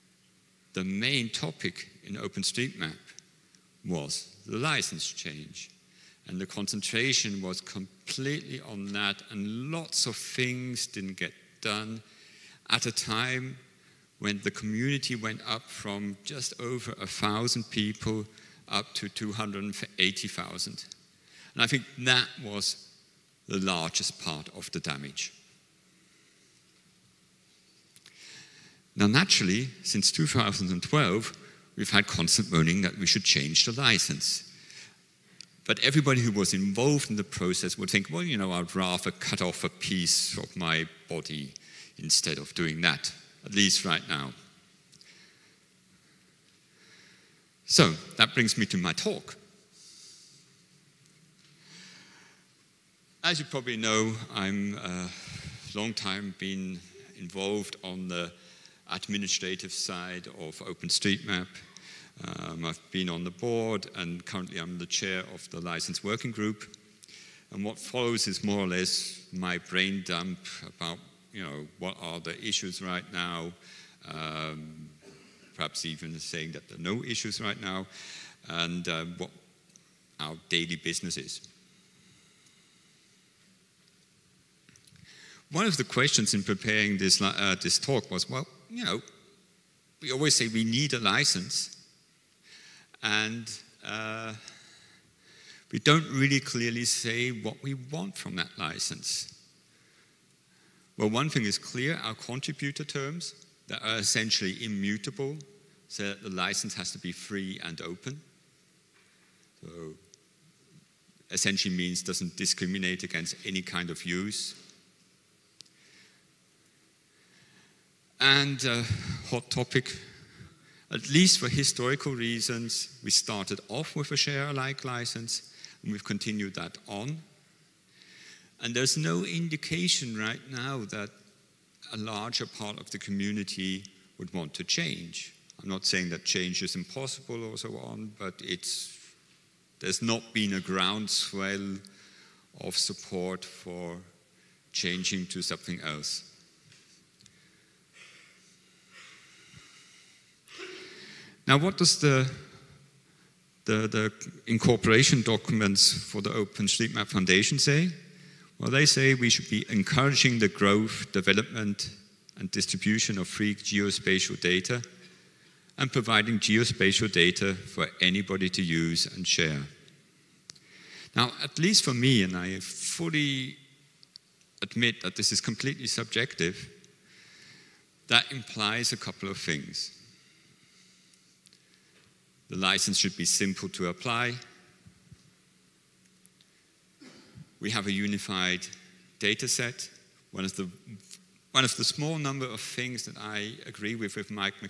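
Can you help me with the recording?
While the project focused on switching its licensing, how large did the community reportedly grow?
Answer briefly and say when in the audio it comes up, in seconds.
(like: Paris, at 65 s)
280,000, at 19 s.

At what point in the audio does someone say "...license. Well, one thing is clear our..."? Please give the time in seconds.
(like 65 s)
98 s.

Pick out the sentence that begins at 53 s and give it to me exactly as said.
As you probably know, I'm a uh, long time been involved on the administrative side of OpenStreetMap.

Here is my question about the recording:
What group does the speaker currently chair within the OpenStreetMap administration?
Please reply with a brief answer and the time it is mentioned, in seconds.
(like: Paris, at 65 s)
license working group, at 65 s.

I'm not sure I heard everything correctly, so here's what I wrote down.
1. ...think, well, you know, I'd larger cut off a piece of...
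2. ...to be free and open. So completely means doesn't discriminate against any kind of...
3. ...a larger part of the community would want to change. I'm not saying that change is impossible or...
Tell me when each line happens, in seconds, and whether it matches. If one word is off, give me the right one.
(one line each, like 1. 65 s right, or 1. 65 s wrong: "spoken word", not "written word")
1. 37 s wrong: "rather", not "larger"
2. 106 s wrong: "essentially", not "completely"
3. 131 s right.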